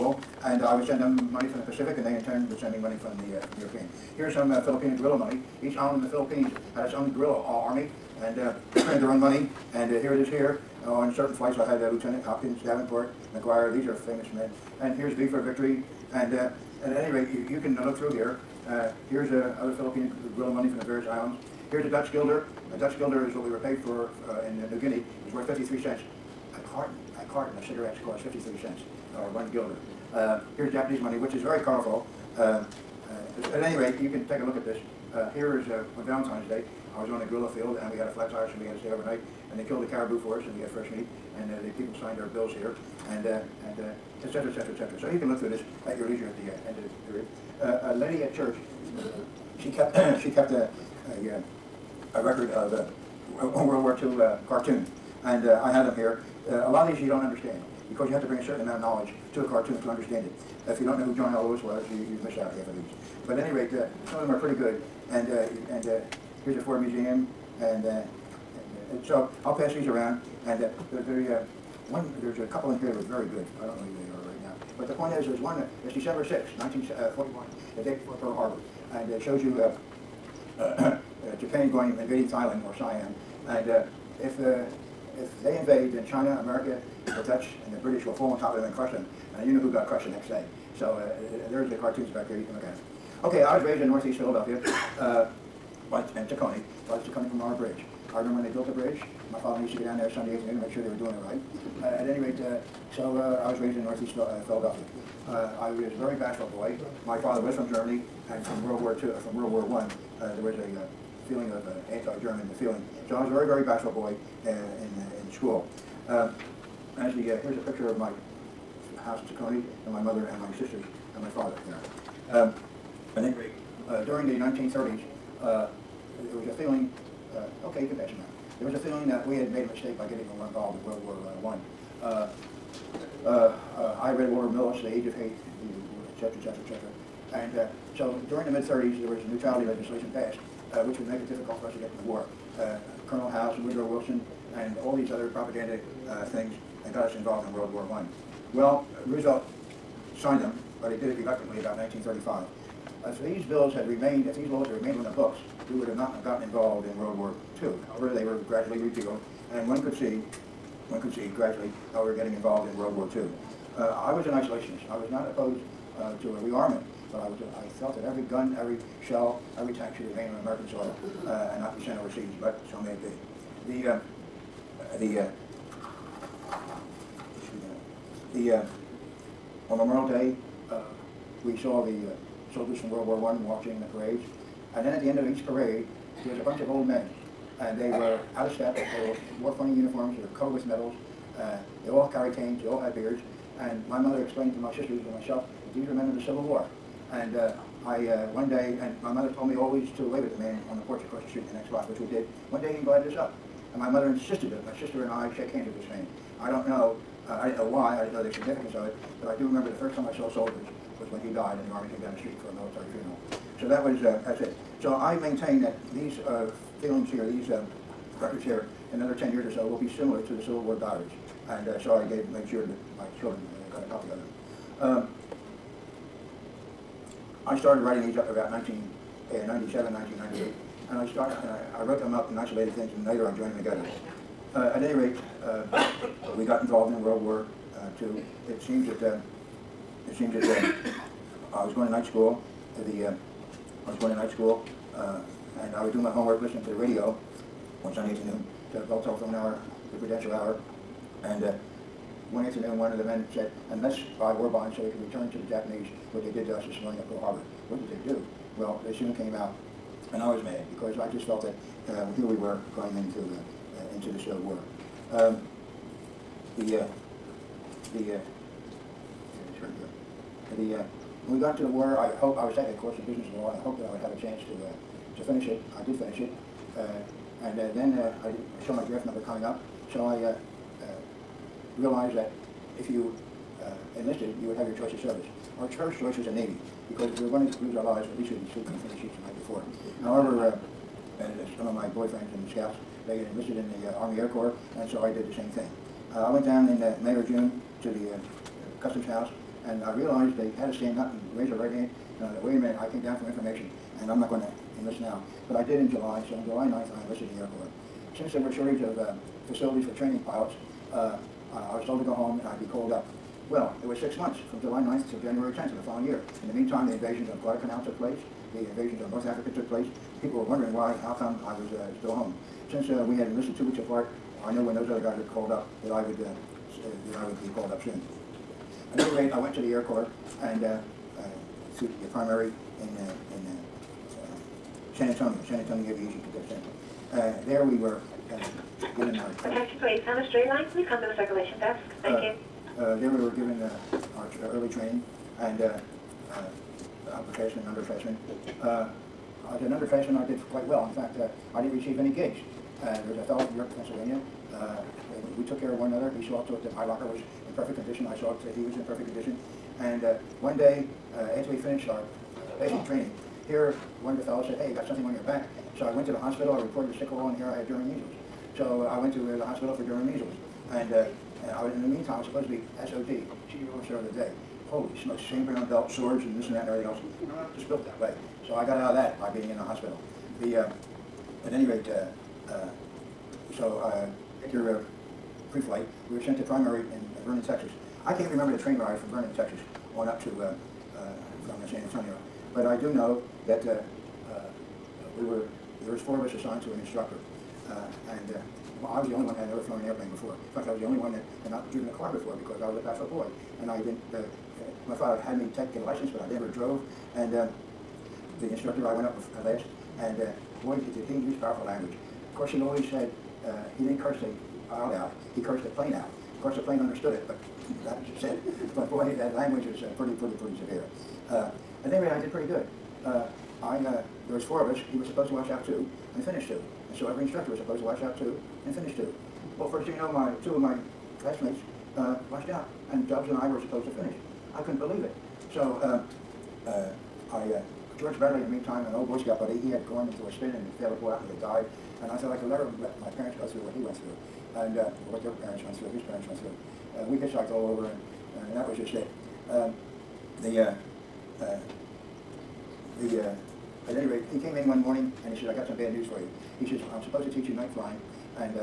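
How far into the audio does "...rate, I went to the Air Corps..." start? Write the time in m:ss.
5:29.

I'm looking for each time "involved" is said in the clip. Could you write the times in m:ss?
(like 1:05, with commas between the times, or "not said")
2:10, 2:27, 2:36, 2:42, 3:56.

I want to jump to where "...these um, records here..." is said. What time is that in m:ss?
3:37.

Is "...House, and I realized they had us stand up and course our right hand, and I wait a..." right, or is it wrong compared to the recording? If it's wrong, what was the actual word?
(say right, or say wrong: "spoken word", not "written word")
wrong: "raise", not "course".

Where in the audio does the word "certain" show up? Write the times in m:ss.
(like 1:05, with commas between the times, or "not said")
0:11, 0:58.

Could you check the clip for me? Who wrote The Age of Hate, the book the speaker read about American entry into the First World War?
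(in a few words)
Walter Millis.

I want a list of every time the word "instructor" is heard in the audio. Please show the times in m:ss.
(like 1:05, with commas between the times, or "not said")
6:36, 6:48, 7:07.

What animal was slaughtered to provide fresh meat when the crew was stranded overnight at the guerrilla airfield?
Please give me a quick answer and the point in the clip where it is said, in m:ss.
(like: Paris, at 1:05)
caribou, at 0:39.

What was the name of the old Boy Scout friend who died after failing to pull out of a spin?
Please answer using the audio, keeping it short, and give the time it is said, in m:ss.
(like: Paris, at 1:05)
George Bradley, at 7:17.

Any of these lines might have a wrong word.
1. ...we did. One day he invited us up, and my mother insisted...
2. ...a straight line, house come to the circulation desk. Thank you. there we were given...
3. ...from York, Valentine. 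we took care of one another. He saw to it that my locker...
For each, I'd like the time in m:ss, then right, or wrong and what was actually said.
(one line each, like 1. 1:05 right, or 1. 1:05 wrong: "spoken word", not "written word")
1. 3:21 right
2. 5:40 wrong: "please", not "house"
3. 5:53 wrong: "Pennsylvania", not "Valentine".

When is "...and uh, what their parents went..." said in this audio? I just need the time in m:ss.
7:24.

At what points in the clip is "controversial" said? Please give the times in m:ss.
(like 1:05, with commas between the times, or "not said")
not said.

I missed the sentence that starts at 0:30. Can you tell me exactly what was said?
Uh, here's Japanese money, which is very colorful.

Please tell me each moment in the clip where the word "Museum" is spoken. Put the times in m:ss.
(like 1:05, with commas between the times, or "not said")
1:06.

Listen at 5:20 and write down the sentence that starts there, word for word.
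People were wondering why, how come I was uh, still home.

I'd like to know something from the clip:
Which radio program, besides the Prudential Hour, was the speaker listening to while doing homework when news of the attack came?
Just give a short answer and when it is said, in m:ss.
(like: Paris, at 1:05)
Bell Telephone Hour, at 4:08.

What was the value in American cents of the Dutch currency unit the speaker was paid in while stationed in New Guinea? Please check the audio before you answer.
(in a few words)
53 cents.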